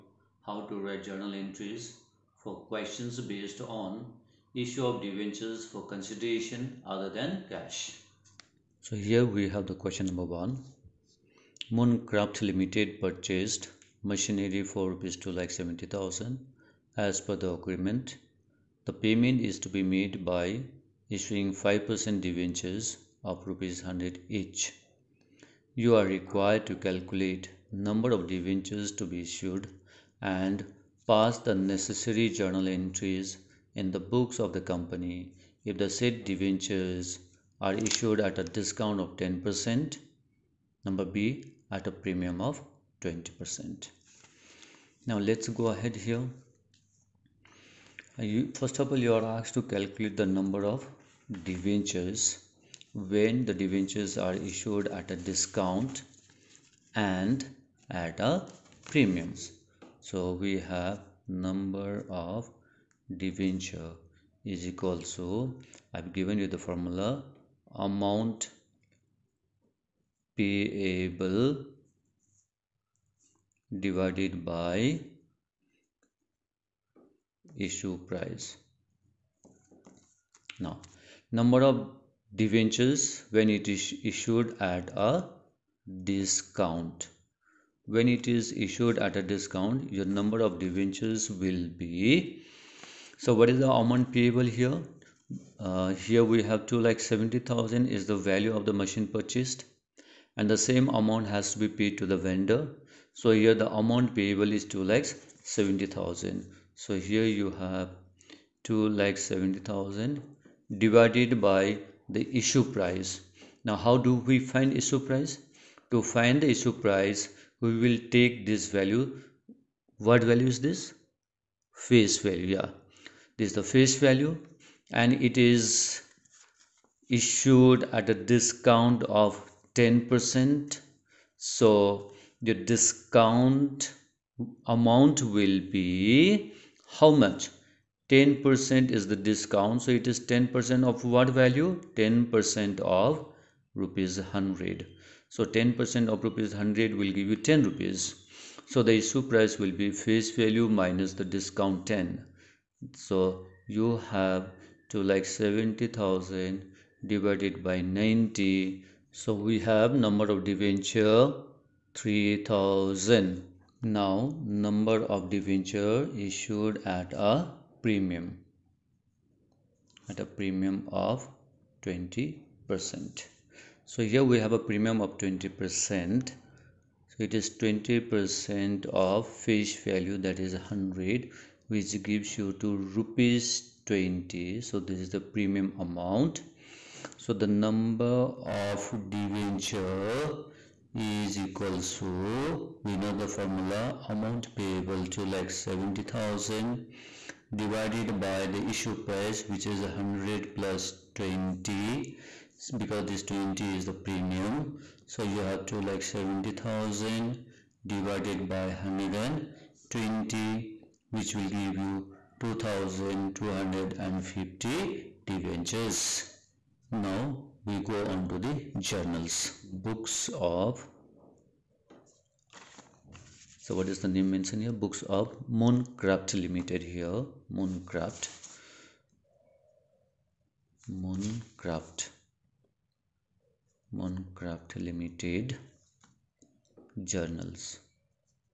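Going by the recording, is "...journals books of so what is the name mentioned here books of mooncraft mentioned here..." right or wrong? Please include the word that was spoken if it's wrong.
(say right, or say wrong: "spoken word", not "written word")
wrong: "limited", not "mentioned".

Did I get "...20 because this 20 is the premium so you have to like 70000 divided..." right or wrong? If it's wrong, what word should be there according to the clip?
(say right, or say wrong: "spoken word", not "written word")
right.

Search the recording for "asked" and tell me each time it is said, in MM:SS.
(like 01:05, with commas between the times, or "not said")
00:49.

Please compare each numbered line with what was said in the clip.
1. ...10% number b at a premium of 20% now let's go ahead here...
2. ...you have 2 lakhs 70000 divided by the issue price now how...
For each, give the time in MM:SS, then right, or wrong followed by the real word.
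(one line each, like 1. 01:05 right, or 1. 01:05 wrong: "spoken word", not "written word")
1. 00:39 right
2. 01:47 right.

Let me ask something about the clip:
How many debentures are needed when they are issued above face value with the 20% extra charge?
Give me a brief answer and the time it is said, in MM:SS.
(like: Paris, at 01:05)
2250, at 03:32.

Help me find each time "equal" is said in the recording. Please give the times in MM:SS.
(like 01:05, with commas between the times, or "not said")
01:04, 03:11.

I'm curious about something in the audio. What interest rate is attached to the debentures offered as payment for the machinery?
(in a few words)
5%.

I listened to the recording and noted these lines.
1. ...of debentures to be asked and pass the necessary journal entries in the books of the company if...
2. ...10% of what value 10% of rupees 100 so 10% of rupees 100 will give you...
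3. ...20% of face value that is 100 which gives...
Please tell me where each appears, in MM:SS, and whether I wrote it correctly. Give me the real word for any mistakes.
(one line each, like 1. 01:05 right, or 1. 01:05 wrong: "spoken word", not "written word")
1. 00:28 wrong: "issued", not "asked"
2. 02:20 right
3. 02:57 right.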